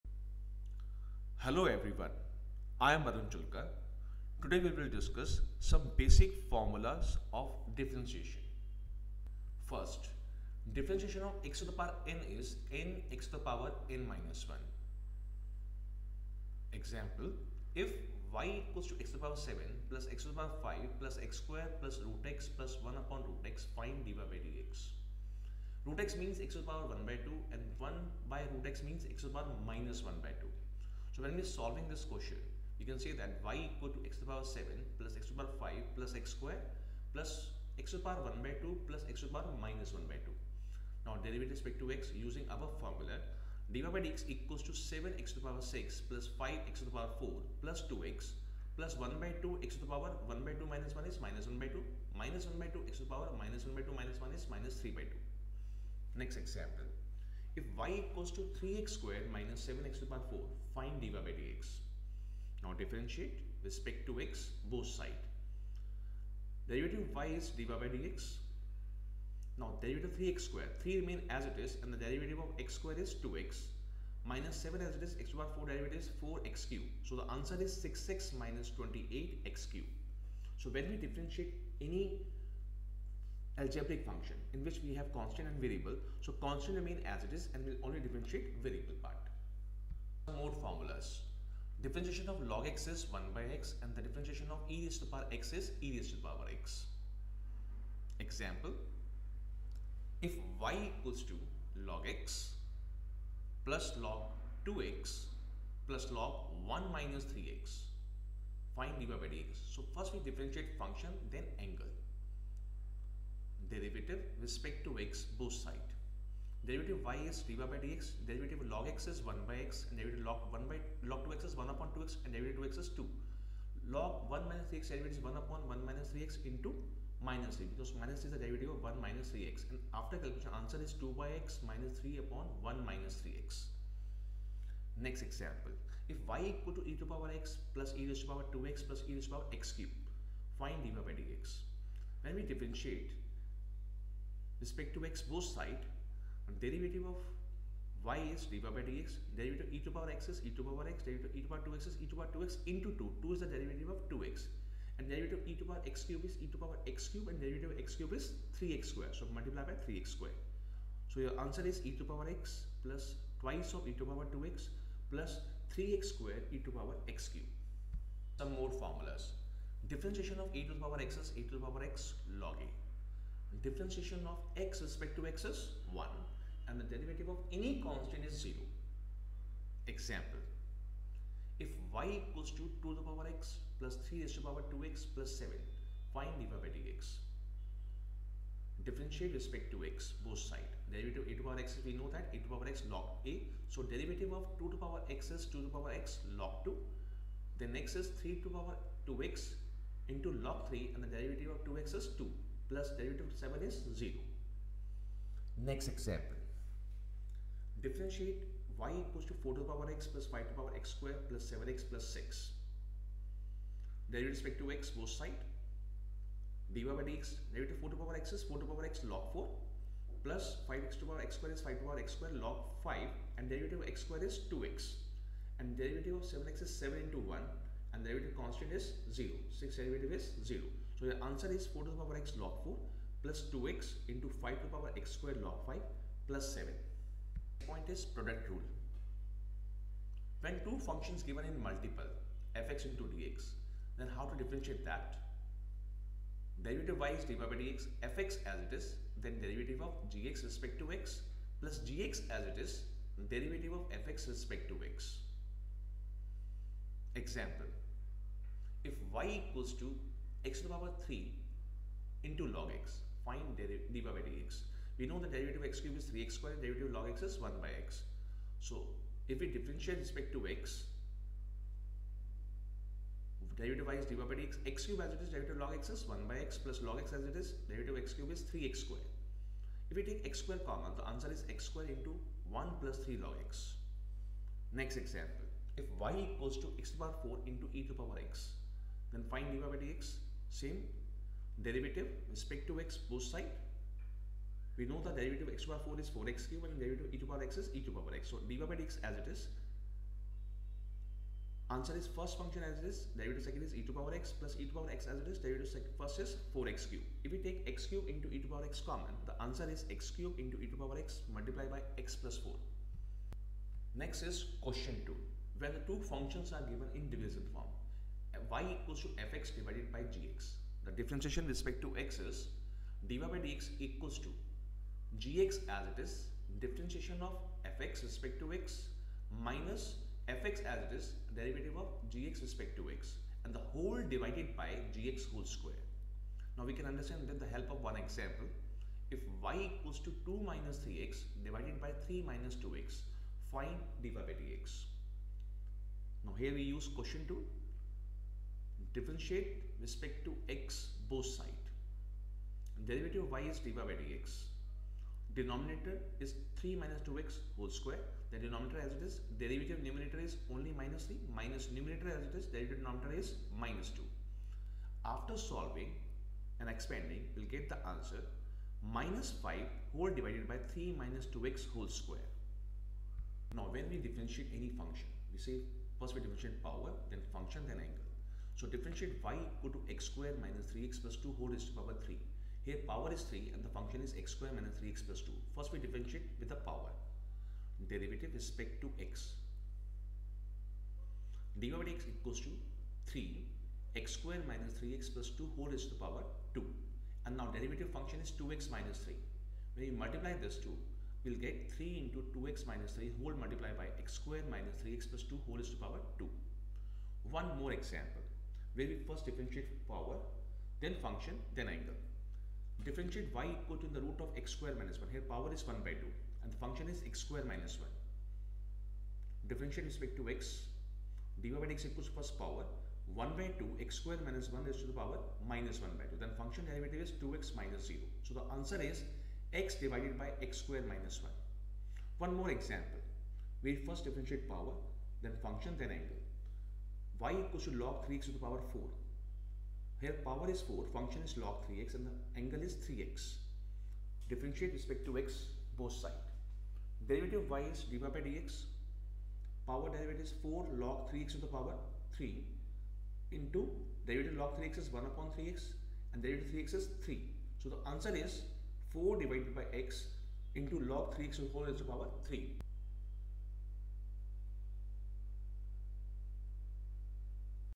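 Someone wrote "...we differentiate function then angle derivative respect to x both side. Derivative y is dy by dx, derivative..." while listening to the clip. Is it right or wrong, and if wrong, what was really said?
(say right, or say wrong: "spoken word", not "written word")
right.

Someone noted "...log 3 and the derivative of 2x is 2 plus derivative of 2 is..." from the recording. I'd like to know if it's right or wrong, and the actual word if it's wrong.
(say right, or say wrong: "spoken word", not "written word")
wrong: "7", not "2".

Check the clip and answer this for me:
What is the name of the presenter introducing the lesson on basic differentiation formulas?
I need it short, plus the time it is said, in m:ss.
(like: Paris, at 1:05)
Arun Julka, at 0:03.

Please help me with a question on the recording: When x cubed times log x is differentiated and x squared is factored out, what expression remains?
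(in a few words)
1 plus 3 log x.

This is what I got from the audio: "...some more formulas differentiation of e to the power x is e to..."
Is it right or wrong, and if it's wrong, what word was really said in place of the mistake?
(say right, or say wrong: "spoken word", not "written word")
right.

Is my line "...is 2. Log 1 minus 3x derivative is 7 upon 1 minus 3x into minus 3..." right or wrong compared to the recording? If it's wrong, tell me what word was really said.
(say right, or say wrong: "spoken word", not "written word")
wrong: "1", not "7".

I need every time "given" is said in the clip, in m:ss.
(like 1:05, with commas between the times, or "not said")
4:01, 5:16.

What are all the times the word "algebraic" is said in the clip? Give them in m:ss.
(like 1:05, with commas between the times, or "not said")
1:23.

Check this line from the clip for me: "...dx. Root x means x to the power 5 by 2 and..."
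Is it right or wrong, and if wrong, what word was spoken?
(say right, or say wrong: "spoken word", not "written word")
wrong: "1", not "5".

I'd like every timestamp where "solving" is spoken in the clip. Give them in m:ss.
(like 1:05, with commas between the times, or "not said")
0:31, 6:05.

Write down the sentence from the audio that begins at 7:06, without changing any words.
Then function derivative is 2x minus 0.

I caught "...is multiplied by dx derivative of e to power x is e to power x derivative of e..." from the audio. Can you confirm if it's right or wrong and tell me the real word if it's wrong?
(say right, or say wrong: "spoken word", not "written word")
wrong: "divided", not "multiplied".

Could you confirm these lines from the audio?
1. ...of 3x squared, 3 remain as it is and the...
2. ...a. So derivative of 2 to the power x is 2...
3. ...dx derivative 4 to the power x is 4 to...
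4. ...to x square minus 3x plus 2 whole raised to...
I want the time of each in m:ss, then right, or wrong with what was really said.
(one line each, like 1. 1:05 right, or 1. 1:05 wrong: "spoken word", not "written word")
1. 1:10 right
2. 3:13 right
3. 3:37 right
4. 6:19 right.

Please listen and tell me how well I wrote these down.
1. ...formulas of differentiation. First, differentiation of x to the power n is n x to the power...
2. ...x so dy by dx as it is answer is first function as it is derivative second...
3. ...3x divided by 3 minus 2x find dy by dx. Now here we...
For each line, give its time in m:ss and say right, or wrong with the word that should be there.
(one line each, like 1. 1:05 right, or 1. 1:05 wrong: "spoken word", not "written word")
1. 0:06 right
2. 4:58 right
3. 5:40 right.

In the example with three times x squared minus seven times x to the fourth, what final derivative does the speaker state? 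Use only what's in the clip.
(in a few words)
6x minus 28x cube.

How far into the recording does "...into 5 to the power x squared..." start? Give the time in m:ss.
3:54.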